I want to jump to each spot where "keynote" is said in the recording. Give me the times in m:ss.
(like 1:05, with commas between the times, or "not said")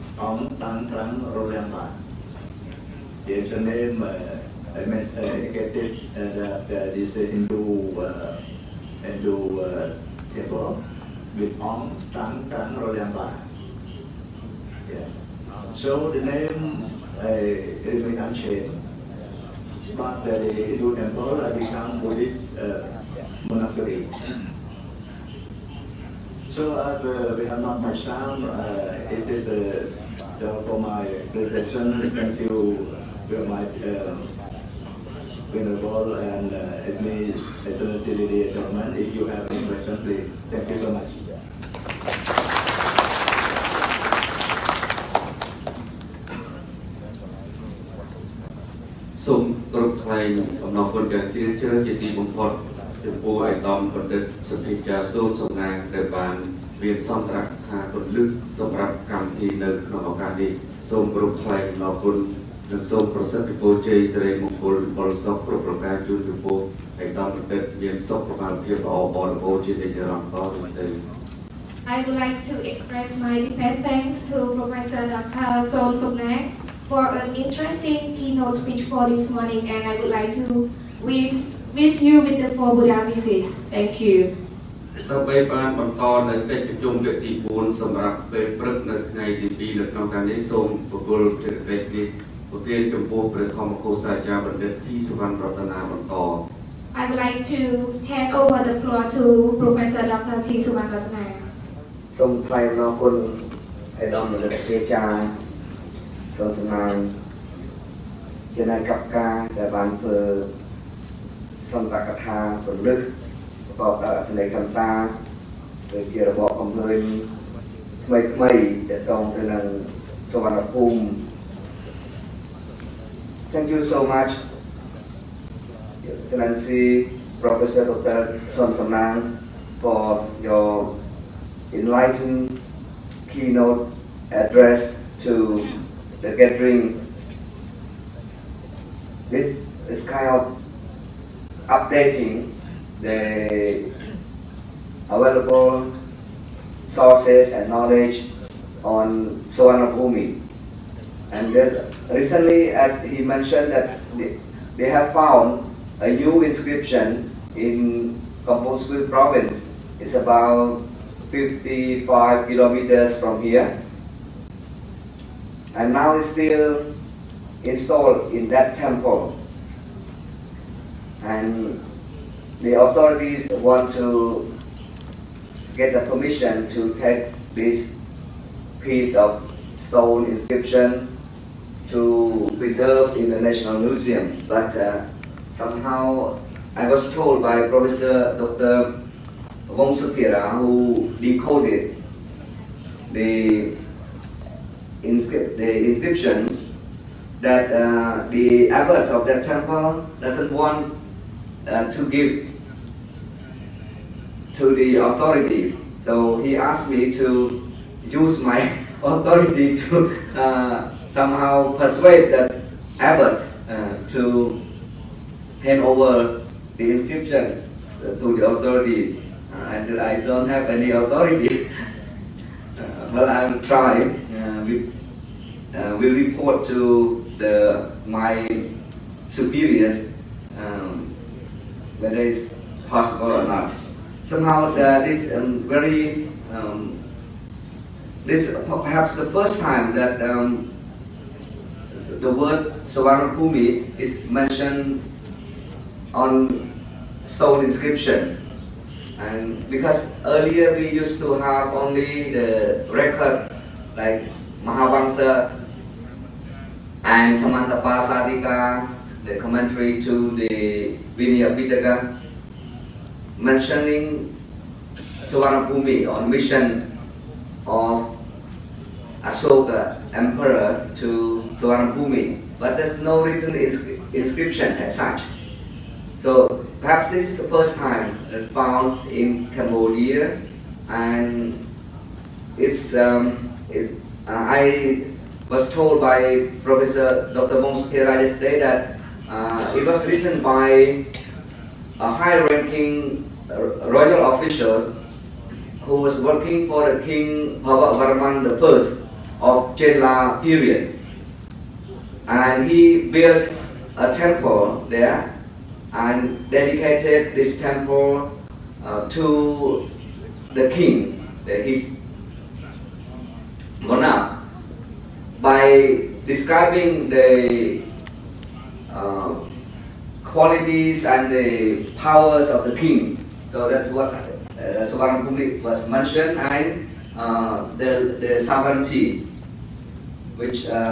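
1:18, 2:13.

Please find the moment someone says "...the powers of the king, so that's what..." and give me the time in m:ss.
5:21.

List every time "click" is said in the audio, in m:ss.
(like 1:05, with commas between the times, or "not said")
not said.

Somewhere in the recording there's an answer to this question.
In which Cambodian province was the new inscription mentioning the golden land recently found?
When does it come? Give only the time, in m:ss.
2:38.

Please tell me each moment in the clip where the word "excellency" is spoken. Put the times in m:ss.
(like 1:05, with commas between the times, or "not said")
0:37, 2:06.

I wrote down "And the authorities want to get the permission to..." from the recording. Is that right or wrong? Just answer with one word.
right.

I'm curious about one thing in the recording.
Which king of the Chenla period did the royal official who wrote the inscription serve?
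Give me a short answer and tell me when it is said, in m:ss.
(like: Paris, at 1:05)
Bhavavarman I, at 4:57.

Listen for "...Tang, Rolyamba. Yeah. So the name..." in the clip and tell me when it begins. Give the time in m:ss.
0:12.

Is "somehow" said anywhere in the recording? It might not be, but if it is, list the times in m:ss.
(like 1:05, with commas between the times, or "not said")
3:05, 3:31, 3:54.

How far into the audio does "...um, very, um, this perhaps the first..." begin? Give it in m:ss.
3:55.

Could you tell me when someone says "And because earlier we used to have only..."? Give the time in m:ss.
4:09.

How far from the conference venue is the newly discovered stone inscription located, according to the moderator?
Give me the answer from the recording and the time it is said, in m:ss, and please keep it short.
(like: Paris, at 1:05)
55 kilometers, at 2:41.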